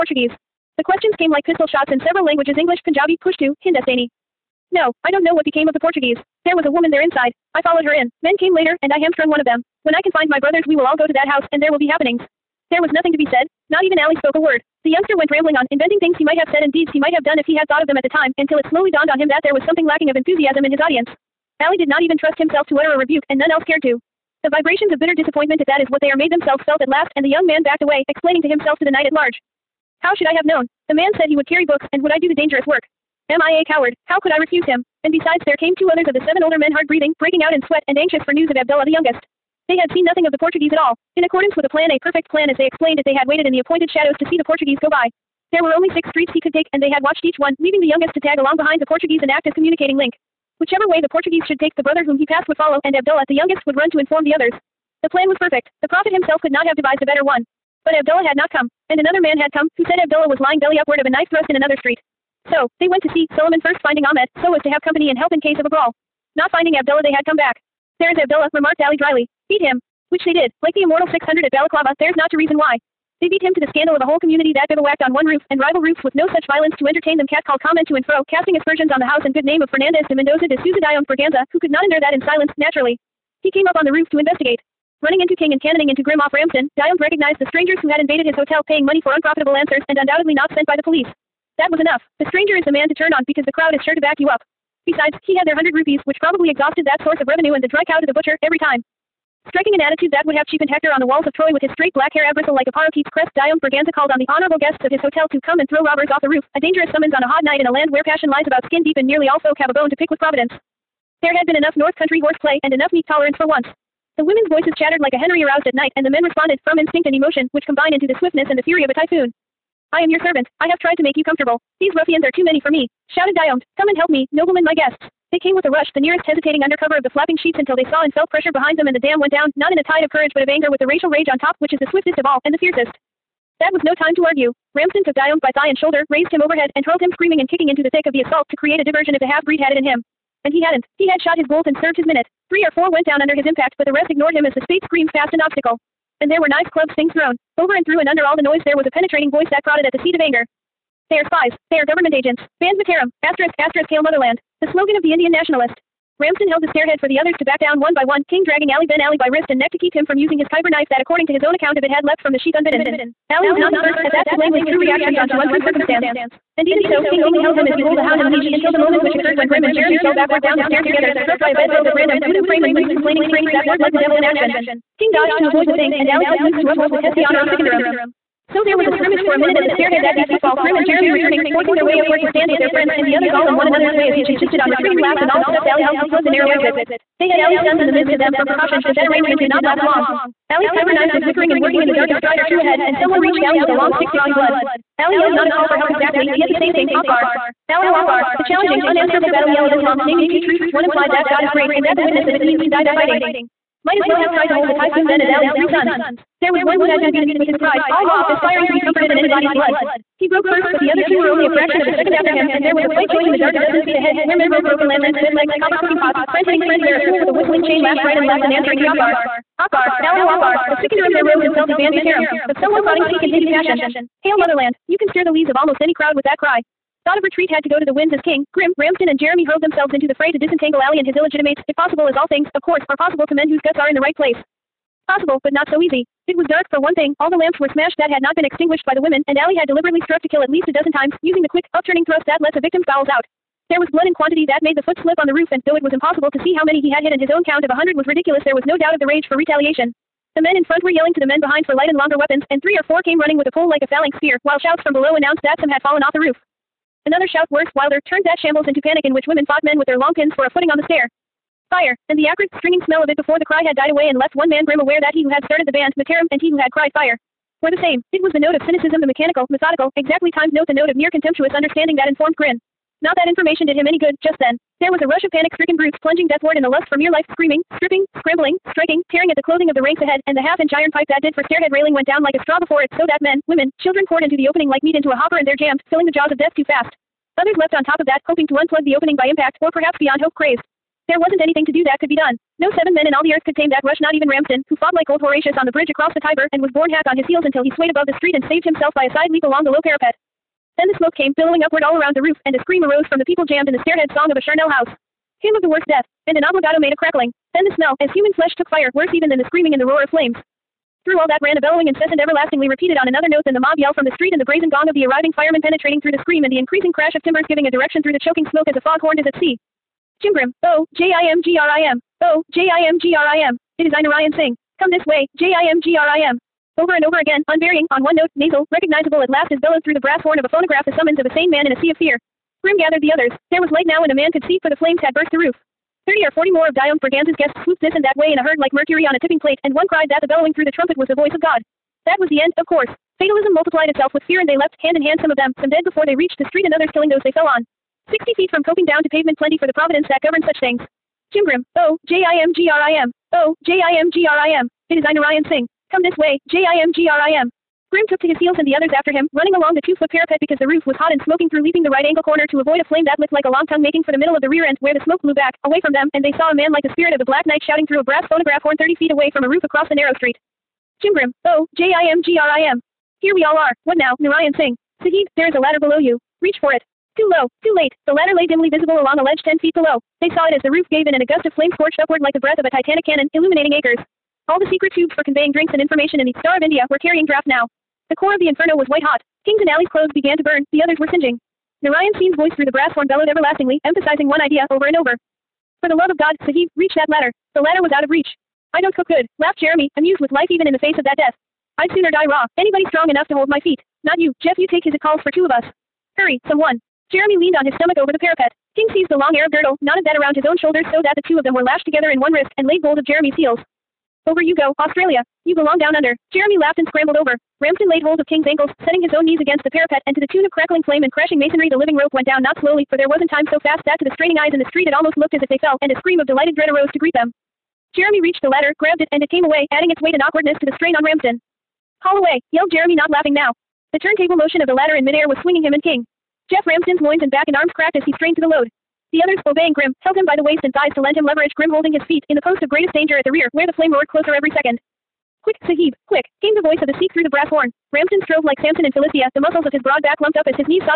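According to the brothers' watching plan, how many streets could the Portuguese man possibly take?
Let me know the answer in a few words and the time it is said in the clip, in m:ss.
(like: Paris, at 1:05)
6, at 0:45.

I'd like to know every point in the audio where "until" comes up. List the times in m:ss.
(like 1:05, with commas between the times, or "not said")
0:18, 2:07, 2:48, 4:57.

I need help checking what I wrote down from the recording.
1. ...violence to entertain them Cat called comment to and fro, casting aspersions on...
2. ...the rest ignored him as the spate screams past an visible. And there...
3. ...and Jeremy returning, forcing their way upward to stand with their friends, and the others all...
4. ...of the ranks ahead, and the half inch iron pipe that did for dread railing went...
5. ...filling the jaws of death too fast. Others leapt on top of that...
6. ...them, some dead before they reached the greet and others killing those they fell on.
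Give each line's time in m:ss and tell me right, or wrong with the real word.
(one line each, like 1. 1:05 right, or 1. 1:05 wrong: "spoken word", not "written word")
1. 1:16 right
2. 2:23 wrong: "obstacle", not "visible"
3. 3:00 right
4. 4:39 wrong: "stairhead", not "dread"
5. 4:45 right
6. 5:45 wrong: "street", not "greet".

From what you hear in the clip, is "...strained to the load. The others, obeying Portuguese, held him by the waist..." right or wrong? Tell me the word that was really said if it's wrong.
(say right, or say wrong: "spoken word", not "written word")
wrong: "Grim", not "Portuguese".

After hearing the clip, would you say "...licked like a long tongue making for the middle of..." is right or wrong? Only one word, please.
right.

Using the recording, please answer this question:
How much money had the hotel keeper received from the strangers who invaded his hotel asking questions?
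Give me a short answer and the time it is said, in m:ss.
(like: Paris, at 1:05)
100 rupees, at 1:35.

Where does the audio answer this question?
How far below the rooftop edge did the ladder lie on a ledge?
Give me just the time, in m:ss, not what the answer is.
6:19.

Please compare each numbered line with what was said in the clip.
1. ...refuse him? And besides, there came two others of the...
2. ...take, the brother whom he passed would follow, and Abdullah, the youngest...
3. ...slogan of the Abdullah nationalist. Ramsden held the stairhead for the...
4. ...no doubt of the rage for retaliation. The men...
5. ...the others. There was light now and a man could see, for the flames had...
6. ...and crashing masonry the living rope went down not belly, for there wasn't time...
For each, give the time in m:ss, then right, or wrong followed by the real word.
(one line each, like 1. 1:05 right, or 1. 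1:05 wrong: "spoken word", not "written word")
1. 0:34 right
2. 0:51 right
3. 2:34 wrong: "Indian", not "Abdullah"
4. 4:08 right
5. 5:33 right
6. 7:01 wrong: "slowly", not "belly".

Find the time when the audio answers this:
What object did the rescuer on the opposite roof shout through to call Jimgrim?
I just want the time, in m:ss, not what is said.
6:08.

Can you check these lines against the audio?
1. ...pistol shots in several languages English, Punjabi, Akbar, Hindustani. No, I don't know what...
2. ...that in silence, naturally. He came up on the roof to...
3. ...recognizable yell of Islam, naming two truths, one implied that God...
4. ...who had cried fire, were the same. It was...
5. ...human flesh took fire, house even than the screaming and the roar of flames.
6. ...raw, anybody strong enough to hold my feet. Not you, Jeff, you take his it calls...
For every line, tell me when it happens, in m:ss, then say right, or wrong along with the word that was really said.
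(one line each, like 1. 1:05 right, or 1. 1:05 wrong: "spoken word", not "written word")
1. 0:01 wrong: "Pushtu", not "Akbar"
2. 1:22 right
3. 3:19 wrong: "battle", not "recognizable"
4. 4:26 right
5. 5:08 wrong: "worse", not "house"
6. 6:42 right.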